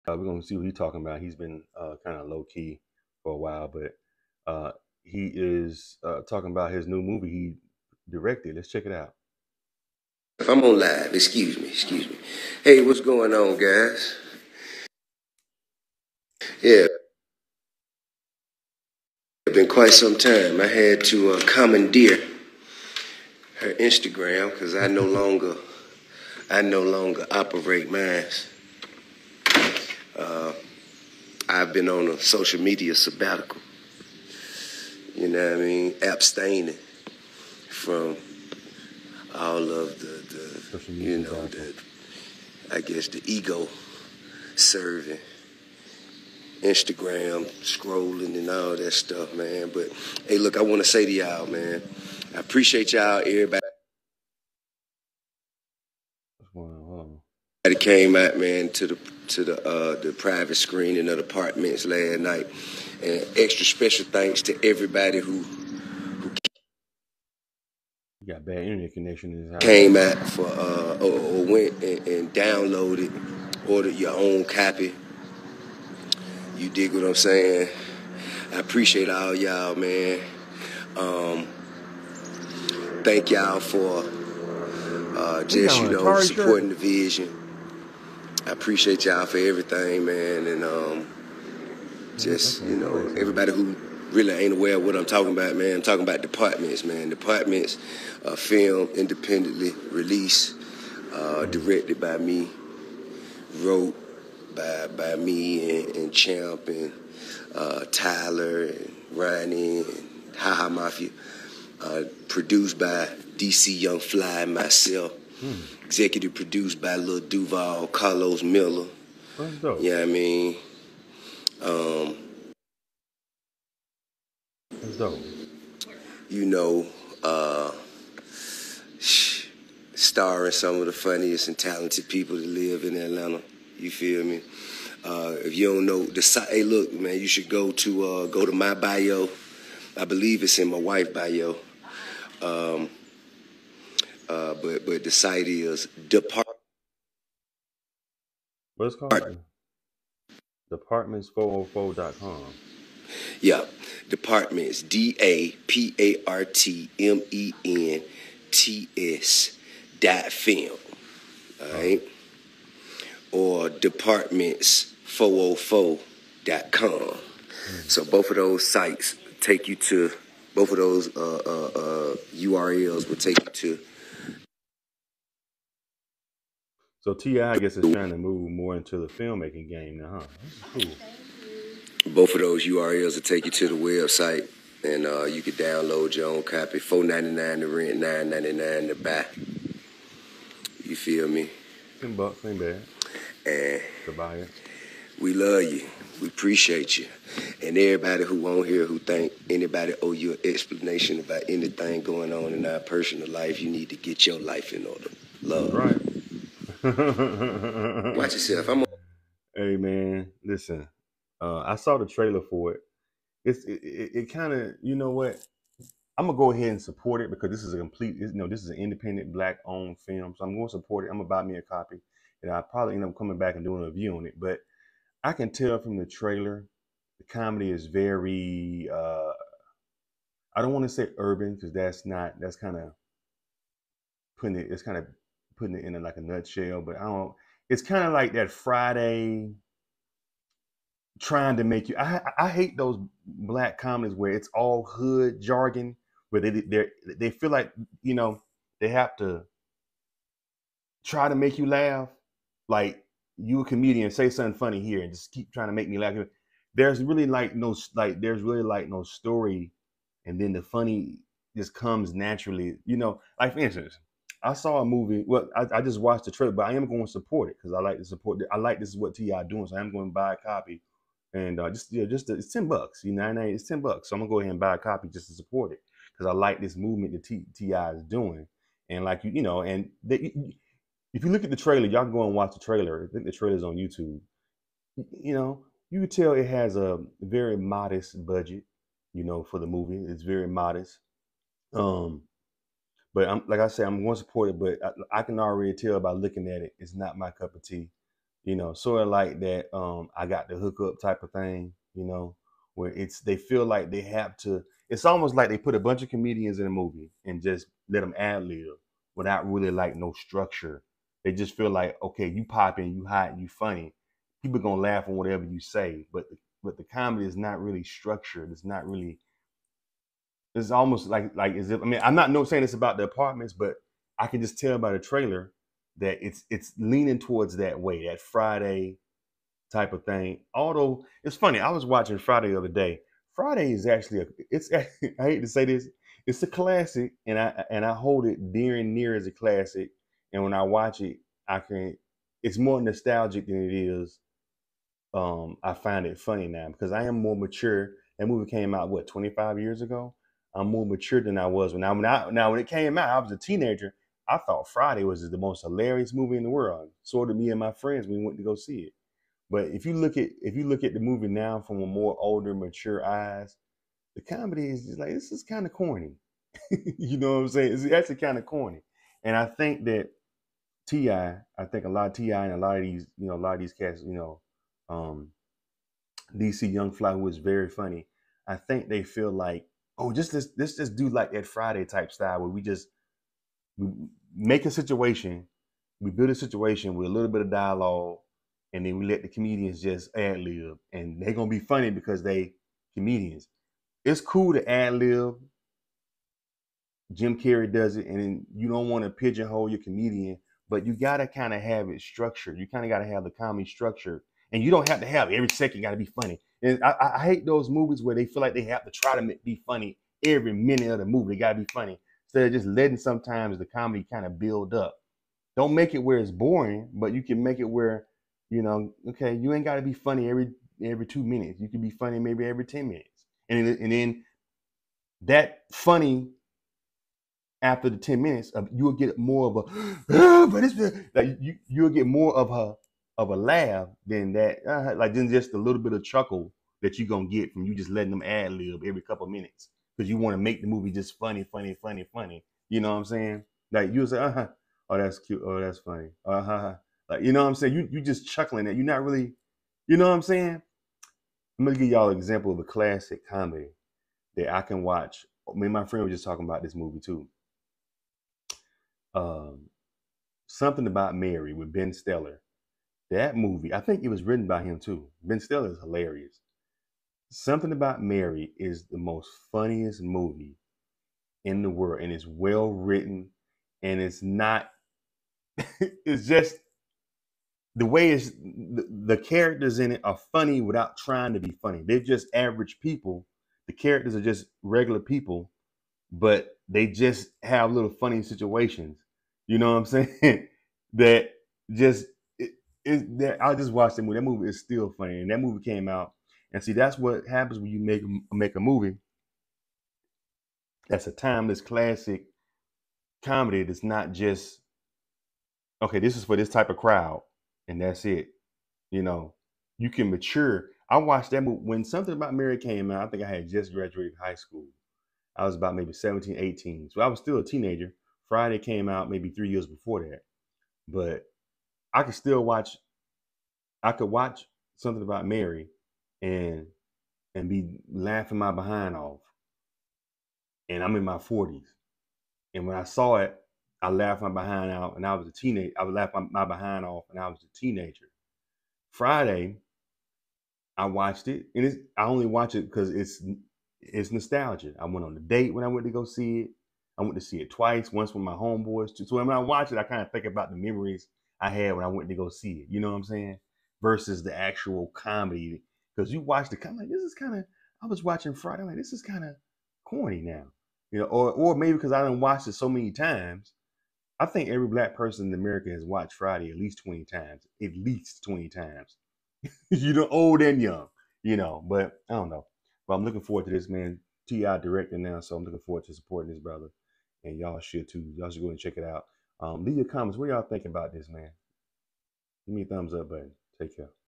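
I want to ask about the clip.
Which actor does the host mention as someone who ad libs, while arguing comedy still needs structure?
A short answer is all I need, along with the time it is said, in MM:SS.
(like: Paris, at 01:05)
Jim Carrey, at 06:37.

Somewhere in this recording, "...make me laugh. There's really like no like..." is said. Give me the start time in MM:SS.
04:15.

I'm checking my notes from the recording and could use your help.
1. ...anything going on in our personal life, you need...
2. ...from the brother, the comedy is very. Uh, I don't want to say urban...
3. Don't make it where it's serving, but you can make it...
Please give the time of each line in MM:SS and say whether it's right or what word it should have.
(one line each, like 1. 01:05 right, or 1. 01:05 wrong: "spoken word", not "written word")
1. 03:21 right
2. 03:45 wrong: "trailer", not "brother"
3. 06:55 wrong: "boring", not "serving".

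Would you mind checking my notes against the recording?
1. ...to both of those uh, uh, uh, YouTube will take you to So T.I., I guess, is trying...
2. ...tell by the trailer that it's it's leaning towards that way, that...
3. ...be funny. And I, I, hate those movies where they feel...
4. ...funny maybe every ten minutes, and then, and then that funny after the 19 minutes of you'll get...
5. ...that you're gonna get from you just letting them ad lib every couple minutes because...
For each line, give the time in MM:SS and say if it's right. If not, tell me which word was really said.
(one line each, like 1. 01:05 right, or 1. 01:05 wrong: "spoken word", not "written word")
1. 02:49 wrong: "URLs", not "YouTube"
2. 05:24 right
3. 06:45 right
4. 07:01 wrong: "10", not "19"
5. 07:16 right.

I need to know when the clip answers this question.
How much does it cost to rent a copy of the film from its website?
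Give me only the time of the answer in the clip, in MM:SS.
03:06.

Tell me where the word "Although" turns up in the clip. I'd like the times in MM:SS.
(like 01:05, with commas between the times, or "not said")
05:30.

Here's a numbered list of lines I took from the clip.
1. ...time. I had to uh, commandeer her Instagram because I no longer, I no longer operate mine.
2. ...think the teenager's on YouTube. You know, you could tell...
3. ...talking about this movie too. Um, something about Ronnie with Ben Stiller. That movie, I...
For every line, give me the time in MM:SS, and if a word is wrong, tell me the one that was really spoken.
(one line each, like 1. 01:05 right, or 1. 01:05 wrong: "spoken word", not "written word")
1. 00:20 right
2. 04:43 wrong: "trailer", not "teenager"
3. 07:36 wrong: "Mary", not "Ronnie".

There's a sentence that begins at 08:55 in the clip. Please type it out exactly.
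I was laughing my behind off, and I was a teenager.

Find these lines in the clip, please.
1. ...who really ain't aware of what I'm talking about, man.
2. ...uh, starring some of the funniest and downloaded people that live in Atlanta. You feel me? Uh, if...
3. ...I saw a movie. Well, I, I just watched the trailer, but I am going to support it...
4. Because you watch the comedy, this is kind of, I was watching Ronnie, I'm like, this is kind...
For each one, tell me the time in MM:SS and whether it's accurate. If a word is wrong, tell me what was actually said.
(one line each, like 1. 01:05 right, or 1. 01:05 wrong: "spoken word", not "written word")
1. 01:33 right
2. 02:07 wrong: "talented", not "downloaded"
3. 04:24 right
4. 09:15 wrong: "Friday", not "Ronnie".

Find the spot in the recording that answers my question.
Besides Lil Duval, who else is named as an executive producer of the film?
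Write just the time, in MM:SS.
01:57.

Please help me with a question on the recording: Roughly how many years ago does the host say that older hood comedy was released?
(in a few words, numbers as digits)
25.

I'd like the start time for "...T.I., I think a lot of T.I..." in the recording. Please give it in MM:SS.
06:10.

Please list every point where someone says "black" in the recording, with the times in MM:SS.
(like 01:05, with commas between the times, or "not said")
03:39, 04:03, 09:24.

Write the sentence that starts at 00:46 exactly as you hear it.
Instagram, scrolling and all that stuff, man.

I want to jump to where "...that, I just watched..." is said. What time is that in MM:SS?
08:13.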